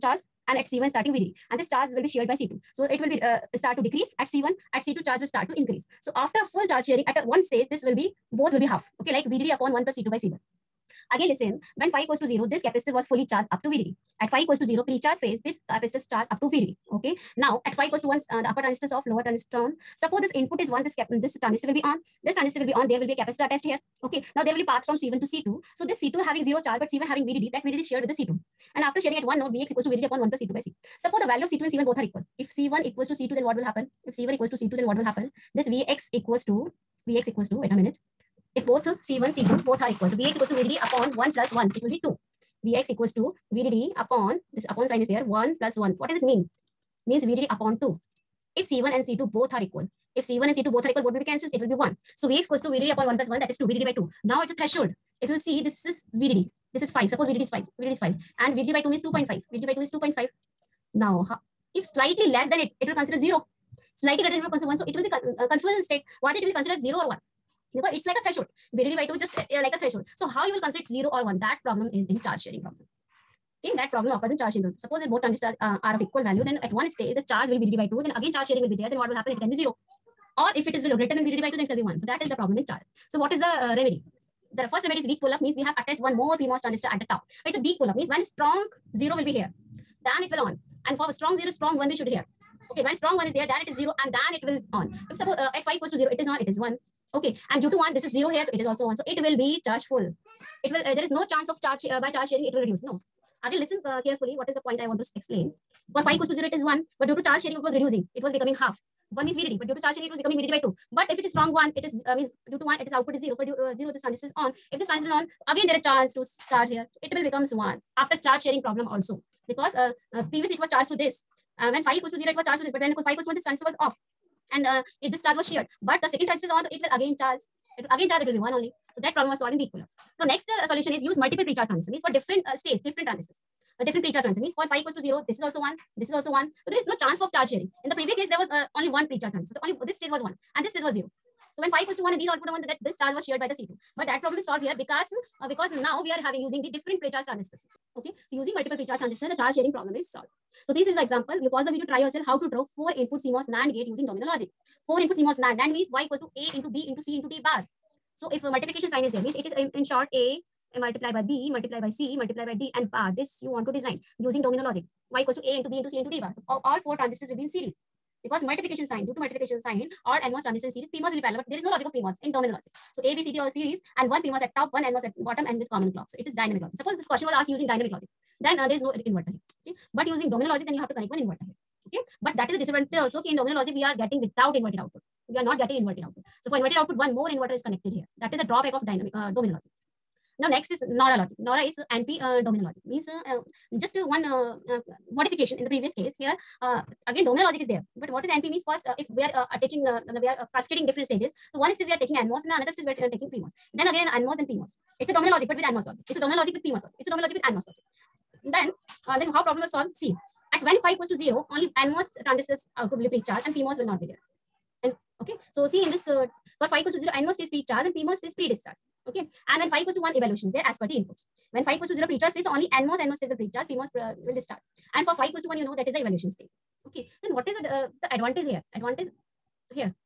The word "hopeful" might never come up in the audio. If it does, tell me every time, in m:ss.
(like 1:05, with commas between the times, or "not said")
not said.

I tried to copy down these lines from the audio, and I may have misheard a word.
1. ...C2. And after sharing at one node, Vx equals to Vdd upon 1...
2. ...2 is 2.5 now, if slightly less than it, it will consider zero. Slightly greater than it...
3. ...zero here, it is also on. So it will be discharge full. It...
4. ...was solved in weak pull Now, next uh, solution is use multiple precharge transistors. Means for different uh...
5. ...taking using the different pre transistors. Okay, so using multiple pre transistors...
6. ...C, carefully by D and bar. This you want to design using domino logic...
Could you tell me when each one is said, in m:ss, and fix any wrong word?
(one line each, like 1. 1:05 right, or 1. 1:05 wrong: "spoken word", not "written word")
1. 0:28 right
2. 0:59 right
3. 1:38 wrong: "charge", not "discharge"
4. 2:09 right
5. 2:26 wrong: "having", not "taking"
6. 2:41 wrong: "multiply", not "carefully".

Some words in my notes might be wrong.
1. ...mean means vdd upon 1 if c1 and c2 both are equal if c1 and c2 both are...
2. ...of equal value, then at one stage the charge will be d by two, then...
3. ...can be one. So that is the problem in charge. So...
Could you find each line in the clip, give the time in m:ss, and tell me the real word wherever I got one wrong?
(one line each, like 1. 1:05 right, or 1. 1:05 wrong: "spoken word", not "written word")
1. 0:46 wrong: "2", not "1"
2. 1:15 right
3. 1:21 right.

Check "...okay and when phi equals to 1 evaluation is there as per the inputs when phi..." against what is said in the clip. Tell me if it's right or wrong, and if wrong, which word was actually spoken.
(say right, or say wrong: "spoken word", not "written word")
right.